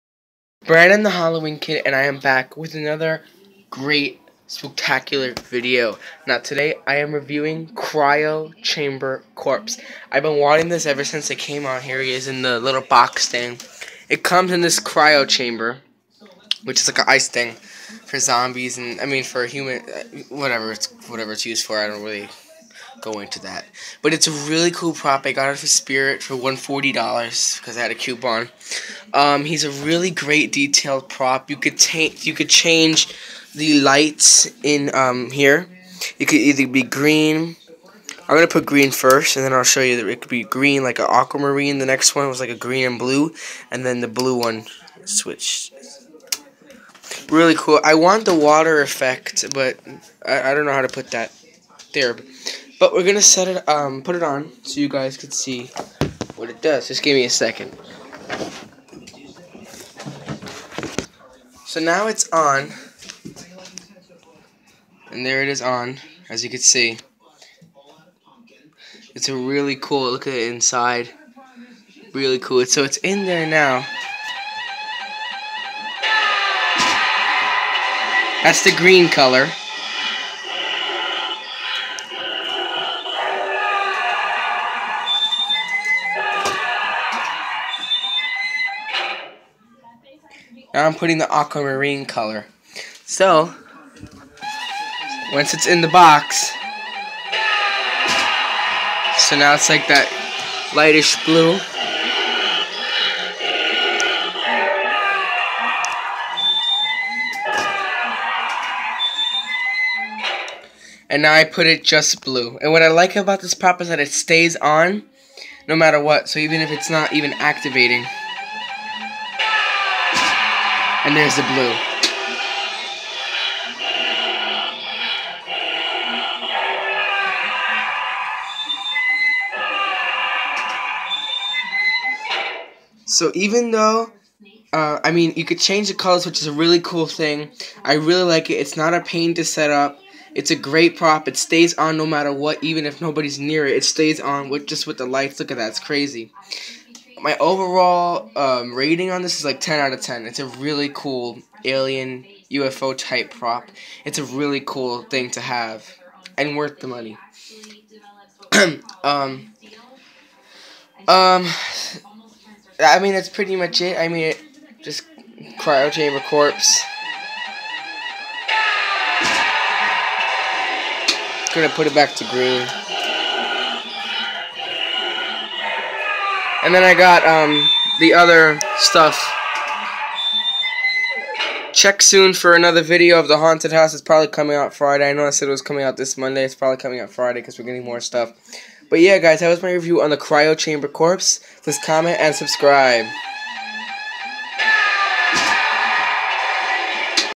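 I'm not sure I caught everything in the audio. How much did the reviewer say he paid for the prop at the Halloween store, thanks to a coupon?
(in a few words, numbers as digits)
$140.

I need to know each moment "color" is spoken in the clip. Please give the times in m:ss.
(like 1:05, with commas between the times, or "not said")
1:19, 1:32, 2:15.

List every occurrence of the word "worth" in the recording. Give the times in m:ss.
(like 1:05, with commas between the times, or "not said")
2:36.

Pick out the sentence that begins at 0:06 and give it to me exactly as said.
Now today I am reviewing Cryo Chamber Corpse.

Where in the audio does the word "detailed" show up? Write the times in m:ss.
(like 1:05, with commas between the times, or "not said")
0:30.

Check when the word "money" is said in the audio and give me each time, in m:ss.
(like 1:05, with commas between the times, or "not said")
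2:36.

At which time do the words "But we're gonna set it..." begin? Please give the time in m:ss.
0:52.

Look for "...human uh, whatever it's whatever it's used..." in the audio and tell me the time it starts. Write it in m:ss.
0:19.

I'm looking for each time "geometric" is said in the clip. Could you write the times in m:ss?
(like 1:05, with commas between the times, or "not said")
not said.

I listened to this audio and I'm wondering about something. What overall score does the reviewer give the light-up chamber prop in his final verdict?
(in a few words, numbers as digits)
10 out of 10.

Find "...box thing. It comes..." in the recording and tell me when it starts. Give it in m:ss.
0:12.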